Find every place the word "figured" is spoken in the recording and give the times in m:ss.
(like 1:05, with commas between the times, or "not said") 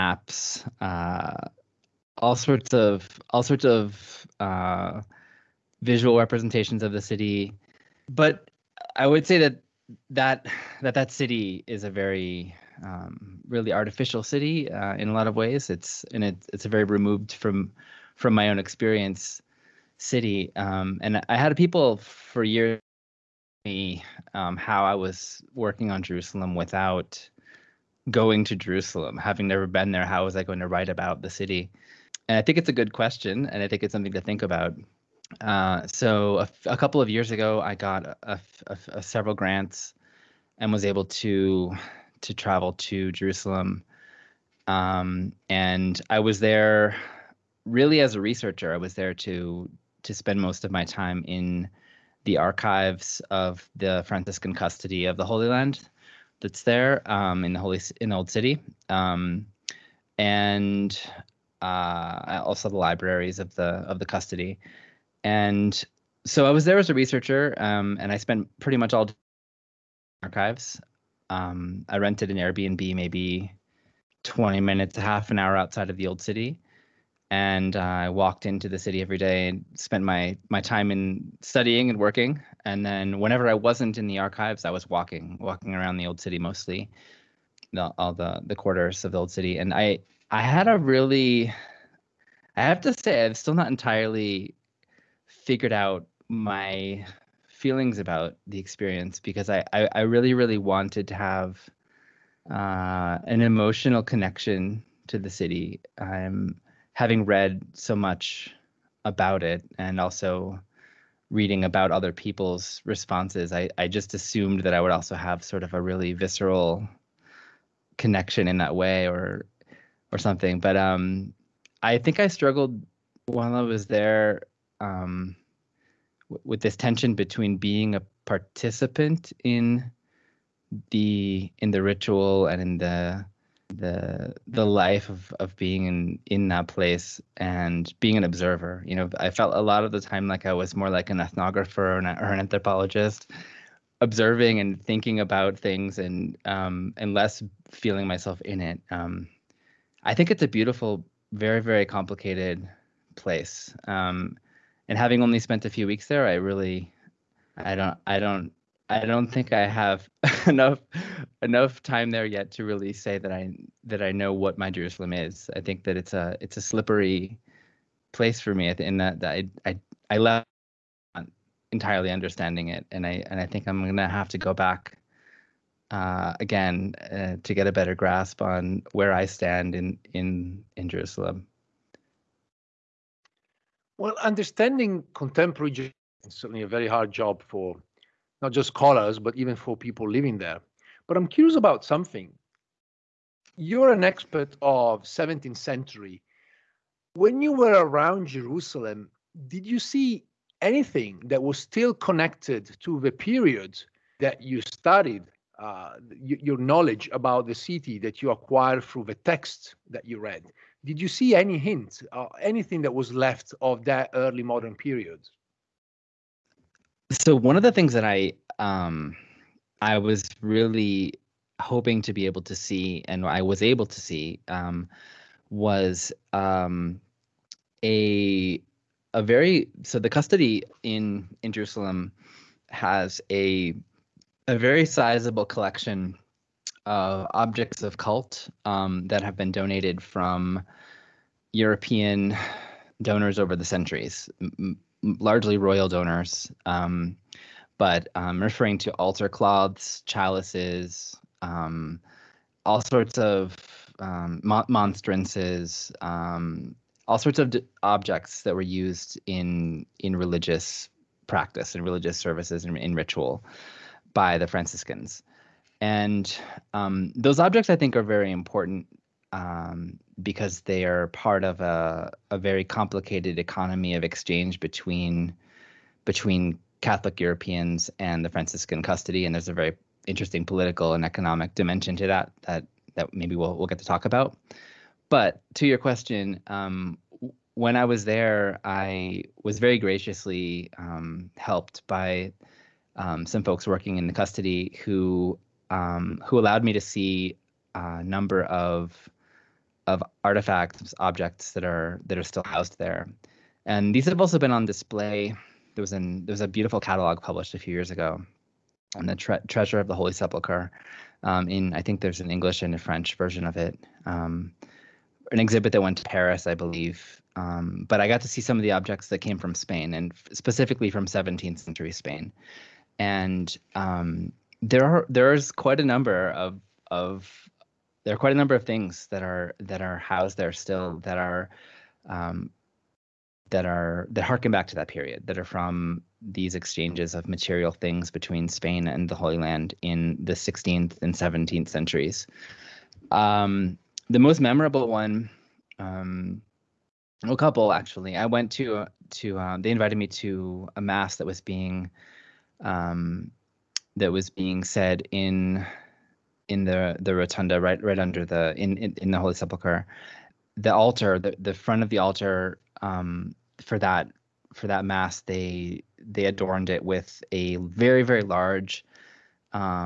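1:35.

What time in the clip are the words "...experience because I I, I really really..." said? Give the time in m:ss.
1:38.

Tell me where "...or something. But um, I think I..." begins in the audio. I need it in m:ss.
2:00.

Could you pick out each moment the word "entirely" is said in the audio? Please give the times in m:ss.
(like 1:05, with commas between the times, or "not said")
1:33, 2:51.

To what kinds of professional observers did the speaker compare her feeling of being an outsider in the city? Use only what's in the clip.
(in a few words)
ethnographer.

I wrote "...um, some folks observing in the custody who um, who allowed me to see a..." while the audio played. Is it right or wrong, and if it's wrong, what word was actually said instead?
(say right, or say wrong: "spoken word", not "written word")
wrong: "working", not "observing".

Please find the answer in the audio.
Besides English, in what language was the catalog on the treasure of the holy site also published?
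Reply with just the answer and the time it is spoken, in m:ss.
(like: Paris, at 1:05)
French, at 5:12.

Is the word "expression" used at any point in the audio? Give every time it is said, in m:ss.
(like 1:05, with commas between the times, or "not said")
not said.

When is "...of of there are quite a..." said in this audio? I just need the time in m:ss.
5:26.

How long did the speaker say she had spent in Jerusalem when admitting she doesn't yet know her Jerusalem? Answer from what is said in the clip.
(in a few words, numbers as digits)
a few weeks.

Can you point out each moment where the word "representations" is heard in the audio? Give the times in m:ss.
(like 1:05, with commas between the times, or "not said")
0:06.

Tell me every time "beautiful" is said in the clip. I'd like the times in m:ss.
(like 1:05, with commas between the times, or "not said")
2:30, 5:06.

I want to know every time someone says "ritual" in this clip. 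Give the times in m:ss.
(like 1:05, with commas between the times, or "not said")
2:11, 4:22.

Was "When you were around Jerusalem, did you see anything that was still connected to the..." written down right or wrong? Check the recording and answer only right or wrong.
right.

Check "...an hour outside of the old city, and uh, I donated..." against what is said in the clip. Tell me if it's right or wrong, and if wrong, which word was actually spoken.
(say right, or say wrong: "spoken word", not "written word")
wrong: "walked", not "donated".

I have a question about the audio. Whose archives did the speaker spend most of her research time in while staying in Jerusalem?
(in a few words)
Franciscan custody of the Holy Land.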